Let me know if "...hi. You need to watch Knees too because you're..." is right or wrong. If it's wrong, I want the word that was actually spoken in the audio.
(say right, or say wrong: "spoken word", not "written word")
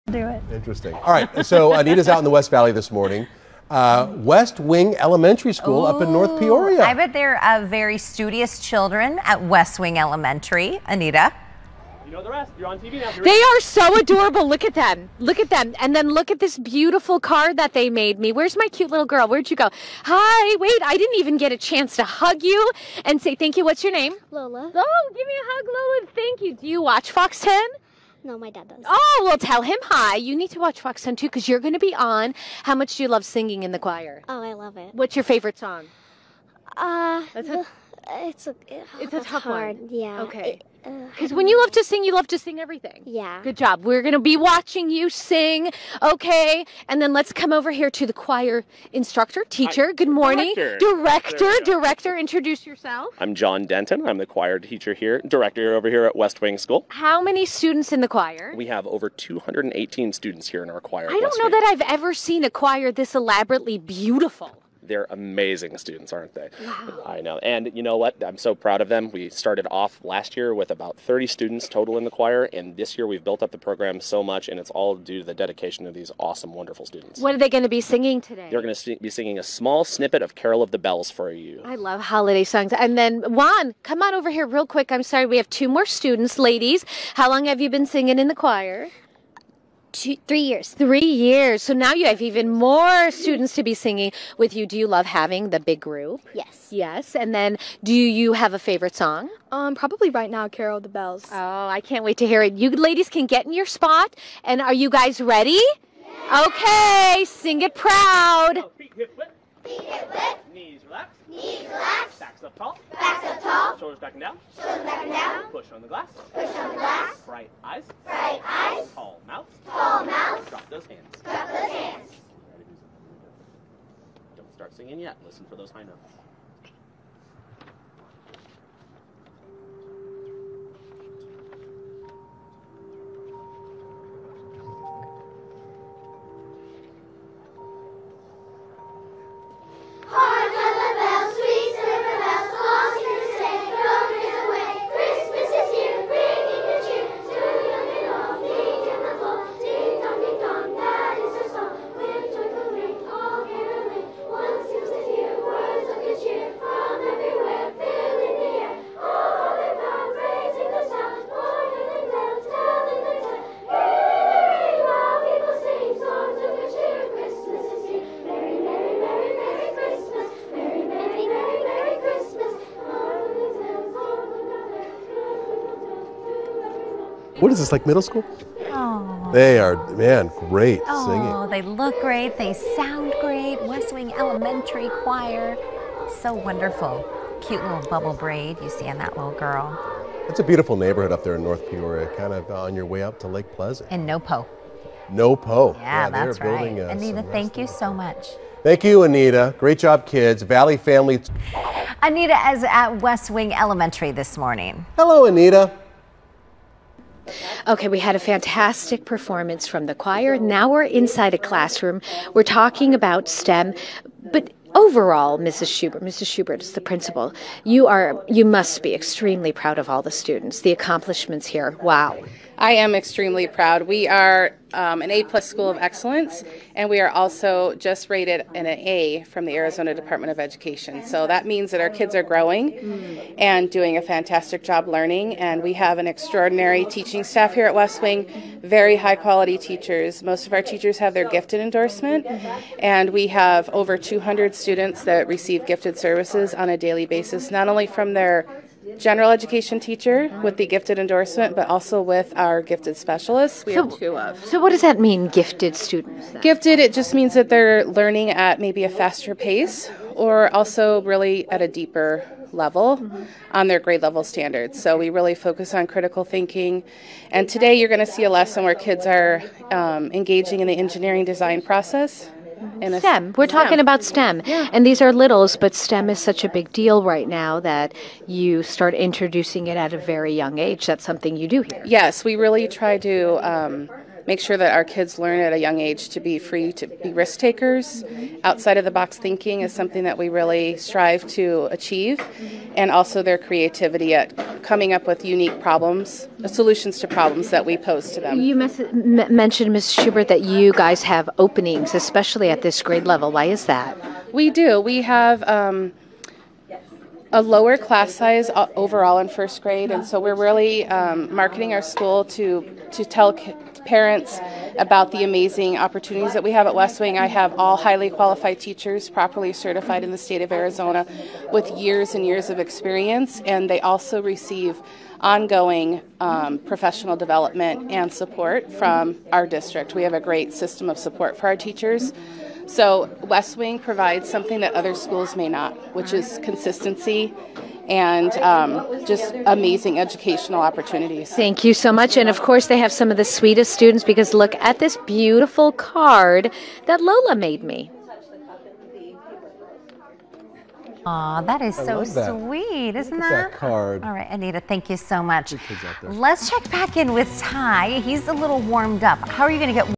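wrong: "Fox", not "Knees".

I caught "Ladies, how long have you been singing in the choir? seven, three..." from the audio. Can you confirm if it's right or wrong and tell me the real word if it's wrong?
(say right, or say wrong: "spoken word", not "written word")
wrong: "two", not "seven".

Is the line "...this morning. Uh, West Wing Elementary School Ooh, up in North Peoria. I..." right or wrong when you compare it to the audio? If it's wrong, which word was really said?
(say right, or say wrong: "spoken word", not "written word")
right.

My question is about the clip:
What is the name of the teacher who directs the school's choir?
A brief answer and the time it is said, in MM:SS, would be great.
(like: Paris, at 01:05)
John Denton, at 00:53.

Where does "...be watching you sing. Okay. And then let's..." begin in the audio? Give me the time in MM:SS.
00:44.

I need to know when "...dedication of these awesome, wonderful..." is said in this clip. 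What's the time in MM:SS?
01:15.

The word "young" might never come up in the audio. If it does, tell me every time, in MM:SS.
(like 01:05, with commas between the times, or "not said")
04:40, 04:45.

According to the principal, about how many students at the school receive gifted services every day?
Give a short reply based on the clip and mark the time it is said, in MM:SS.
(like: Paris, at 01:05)
over 200, at 04:03.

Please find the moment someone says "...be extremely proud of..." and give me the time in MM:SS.
03:38.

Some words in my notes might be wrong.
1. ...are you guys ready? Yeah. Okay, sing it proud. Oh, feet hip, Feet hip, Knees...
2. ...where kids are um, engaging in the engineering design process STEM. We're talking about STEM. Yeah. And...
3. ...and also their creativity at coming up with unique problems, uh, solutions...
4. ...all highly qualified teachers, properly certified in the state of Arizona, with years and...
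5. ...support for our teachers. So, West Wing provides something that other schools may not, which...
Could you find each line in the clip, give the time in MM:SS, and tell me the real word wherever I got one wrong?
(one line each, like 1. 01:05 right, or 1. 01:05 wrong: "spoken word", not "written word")
1. 01:44 right
2. 04:28 right
3. 04:52 right
4. 05:17 right
5. 05:30 right.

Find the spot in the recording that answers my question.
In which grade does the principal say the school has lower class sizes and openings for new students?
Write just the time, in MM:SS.
05:09.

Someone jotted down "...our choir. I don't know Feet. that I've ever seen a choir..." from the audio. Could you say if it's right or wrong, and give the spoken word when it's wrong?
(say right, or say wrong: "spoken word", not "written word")
wrong: "Wing", not "Feet".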